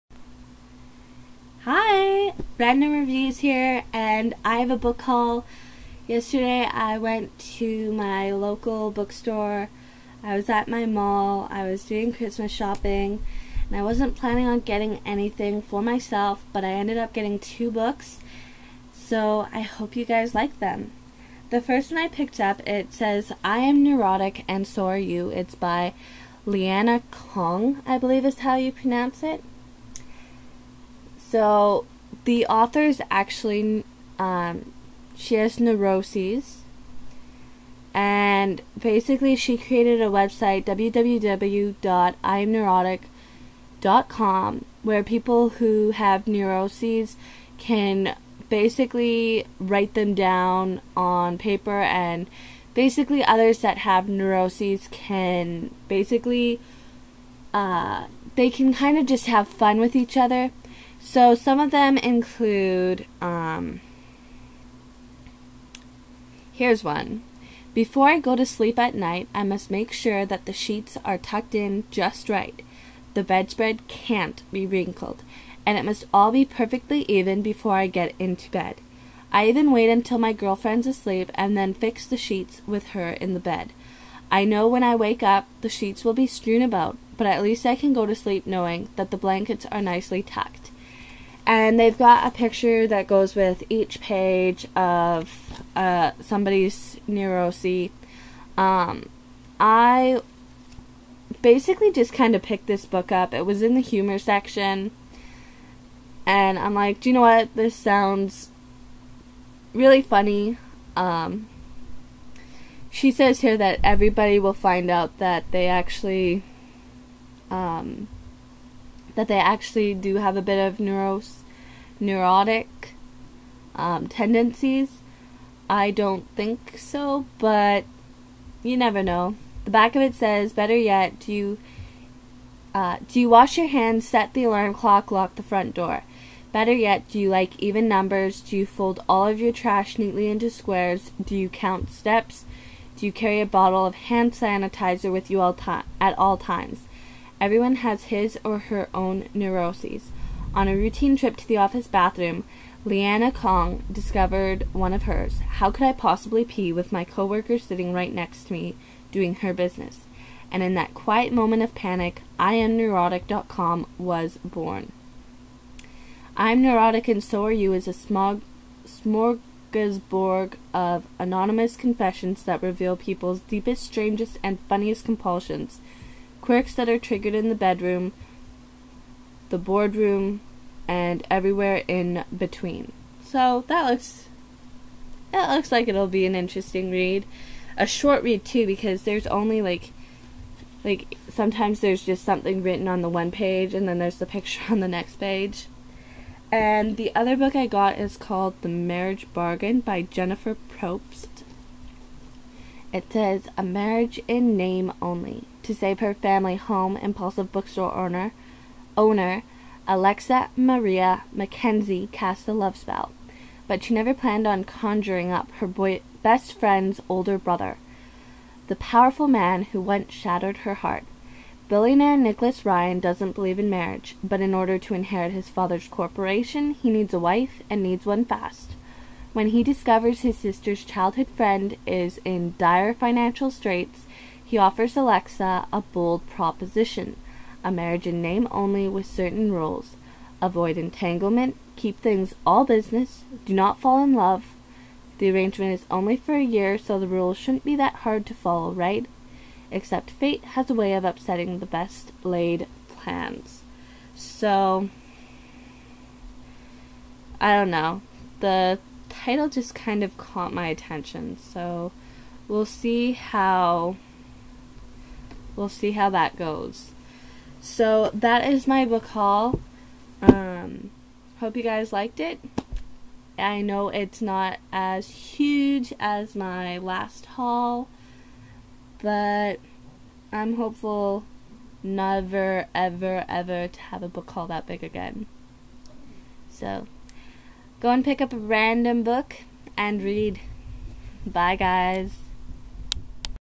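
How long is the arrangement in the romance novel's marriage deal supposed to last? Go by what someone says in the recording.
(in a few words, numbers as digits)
A year.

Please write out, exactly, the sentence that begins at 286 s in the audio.
So go and pick up a random book and read.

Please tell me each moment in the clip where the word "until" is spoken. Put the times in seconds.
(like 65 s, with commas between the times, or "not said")
79 s.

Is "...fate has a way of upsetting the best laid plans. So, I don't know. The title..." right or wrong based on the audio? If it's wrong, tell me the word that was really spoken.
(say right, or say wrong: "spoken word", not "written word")
right.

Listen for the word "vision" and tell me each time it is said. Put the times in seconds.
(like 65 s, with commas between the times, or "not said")
not said.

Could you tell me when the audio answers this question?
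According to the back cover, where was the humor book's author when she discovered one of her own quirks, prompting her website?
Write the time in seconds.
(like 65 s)
151 s.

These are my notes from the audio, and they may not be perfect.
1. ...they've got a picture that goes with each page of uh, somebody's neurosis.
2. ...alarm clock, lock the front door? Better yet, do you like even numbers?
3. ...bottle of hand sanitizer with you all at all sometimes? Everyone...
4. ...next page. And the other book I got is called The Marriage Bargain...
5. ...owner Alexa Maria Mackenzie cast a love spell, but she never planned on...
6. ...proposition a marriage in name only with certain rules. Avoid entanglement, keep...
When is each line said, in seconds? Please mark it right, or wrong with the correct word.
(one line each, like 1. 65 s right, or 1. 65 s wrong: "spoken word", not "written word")
1. 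91 s right
2. 134 s right
3. 143 s wrong: "times", not "sometimes"
4. 194 s right
5. 208 s right
6. 236 s right.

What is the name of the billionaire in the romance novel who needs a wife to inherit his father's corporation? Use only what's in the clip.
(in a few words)
Nicholas Ryan.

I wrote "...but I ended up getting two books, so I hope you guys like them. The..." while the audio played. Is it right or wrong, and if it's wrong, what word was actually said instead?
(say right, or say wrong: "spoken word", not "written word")
right.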